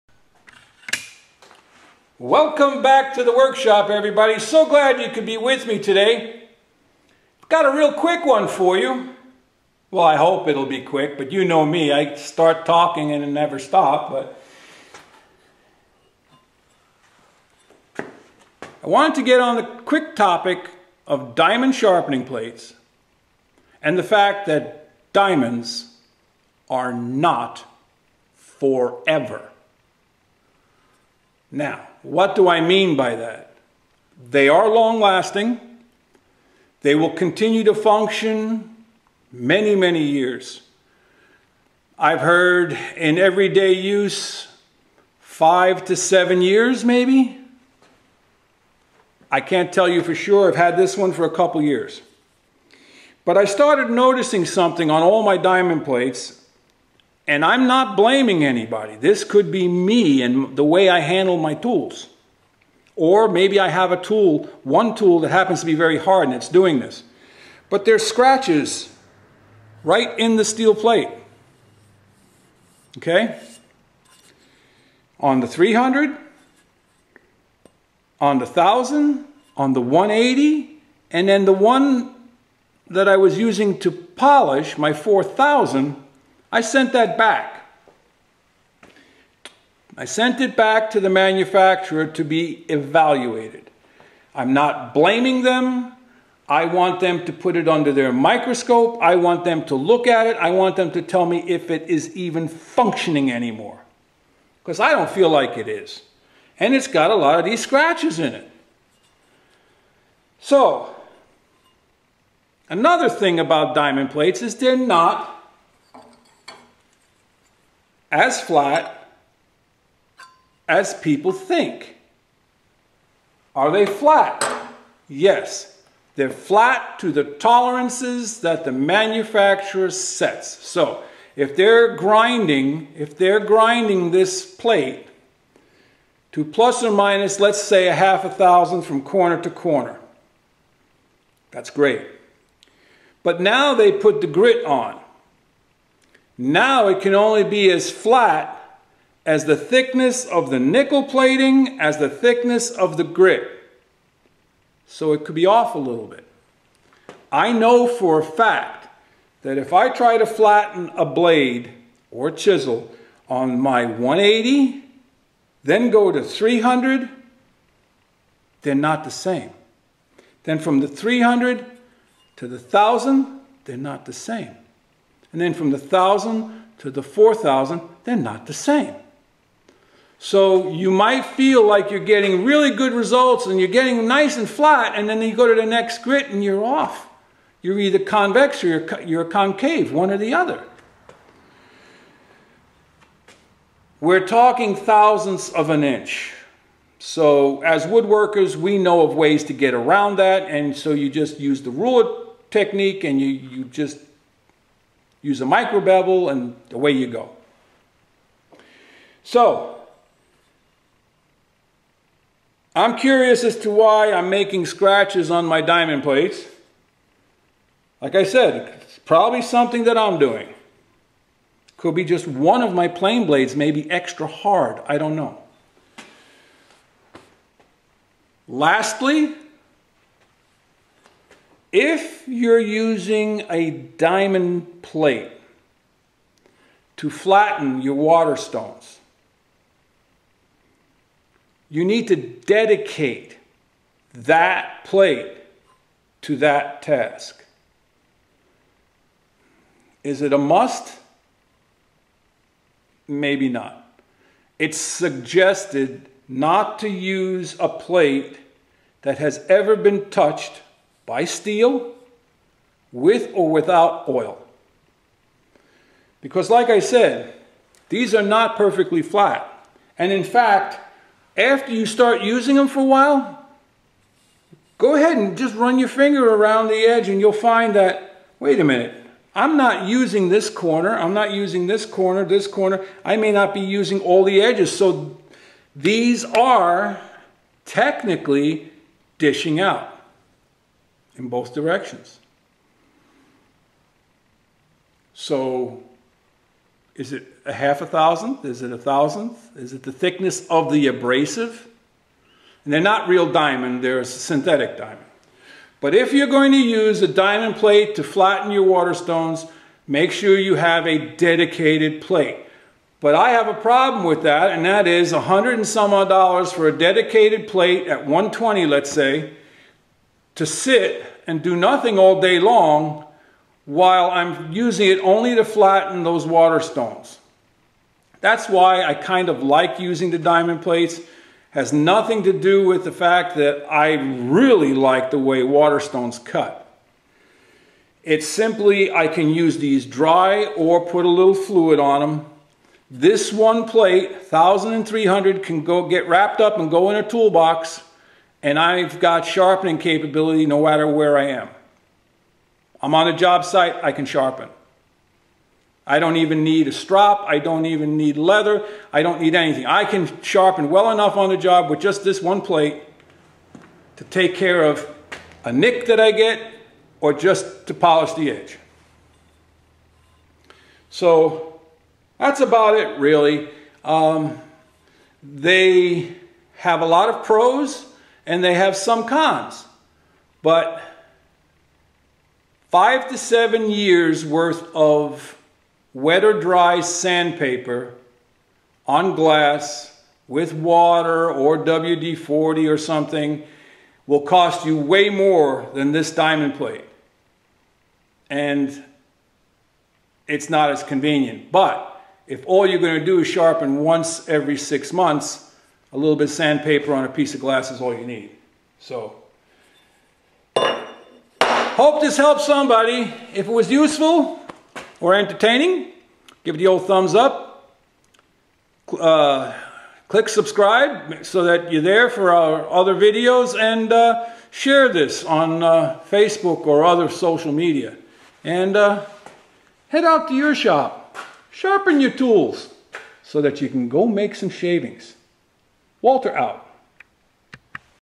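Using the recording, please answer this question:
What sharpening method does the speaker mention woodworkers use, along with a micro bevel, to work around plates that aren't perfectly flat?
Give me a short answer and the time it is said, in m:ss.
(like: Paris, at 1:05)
ruler technique, at 3:21.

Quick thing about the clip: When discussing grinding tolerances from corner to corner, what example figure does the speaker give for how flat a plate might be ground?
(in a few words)
half a thousandth.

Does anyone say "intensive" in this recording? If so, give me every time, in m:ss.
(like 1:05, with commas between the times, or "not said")
not said.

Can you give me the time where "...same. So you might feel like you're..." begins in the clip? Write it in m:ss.
2:58.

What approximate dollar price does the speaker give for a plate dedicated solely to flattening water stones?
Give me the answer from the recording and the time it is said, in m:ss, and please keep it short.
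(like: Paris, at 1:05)
$120, at 5:18.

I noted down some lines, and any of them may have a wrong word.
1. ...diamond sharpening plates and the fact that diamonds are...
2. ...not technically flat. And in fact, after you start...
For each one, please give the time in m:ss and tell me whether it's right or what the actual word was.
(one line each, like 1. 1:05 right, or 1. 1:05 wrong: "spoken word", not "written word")
1. 0:21 right
2. 4:28 wrong: "perfectly", not "technically".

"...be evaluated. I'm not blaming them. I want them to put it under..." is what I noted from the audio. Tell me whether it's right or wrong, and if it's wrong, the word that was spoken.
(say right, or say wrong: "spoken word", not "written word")
right.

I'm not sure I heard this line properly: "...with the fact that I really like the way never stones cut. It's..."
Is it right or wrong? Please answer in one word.
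wrong.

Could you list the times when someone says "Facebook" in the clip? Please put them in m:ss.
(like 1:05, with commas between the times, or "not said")
7:06.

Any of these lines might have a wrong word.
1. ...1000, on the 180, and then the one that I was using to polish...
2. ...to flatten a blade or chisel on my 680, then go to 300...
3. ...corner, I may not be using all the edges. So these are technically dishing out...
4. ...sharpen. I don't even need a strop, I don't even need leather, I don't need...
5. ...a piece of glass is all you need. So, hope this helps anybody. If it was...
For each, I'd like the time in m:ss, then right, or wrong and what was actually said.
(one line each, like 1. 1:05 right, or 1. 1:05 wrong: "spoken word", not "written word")
1. 1:18 right
2. 2:40 wrong: "180", not "680"
3. 4:42 right
4. 5:54 right
5. 6:47 wrong: "somebody", not "anybody".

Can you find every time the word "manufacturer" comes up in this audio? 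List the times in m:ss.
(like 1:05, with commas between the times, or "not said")
1:31, 2:08.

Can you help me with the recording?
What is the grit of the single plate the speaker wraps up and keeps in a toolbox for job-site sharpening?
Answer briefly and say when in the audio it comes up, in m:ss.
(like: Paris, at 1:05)
1300, at 5:44.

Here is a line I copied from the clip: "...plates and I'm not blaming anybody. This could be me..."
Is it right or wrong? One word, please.
right.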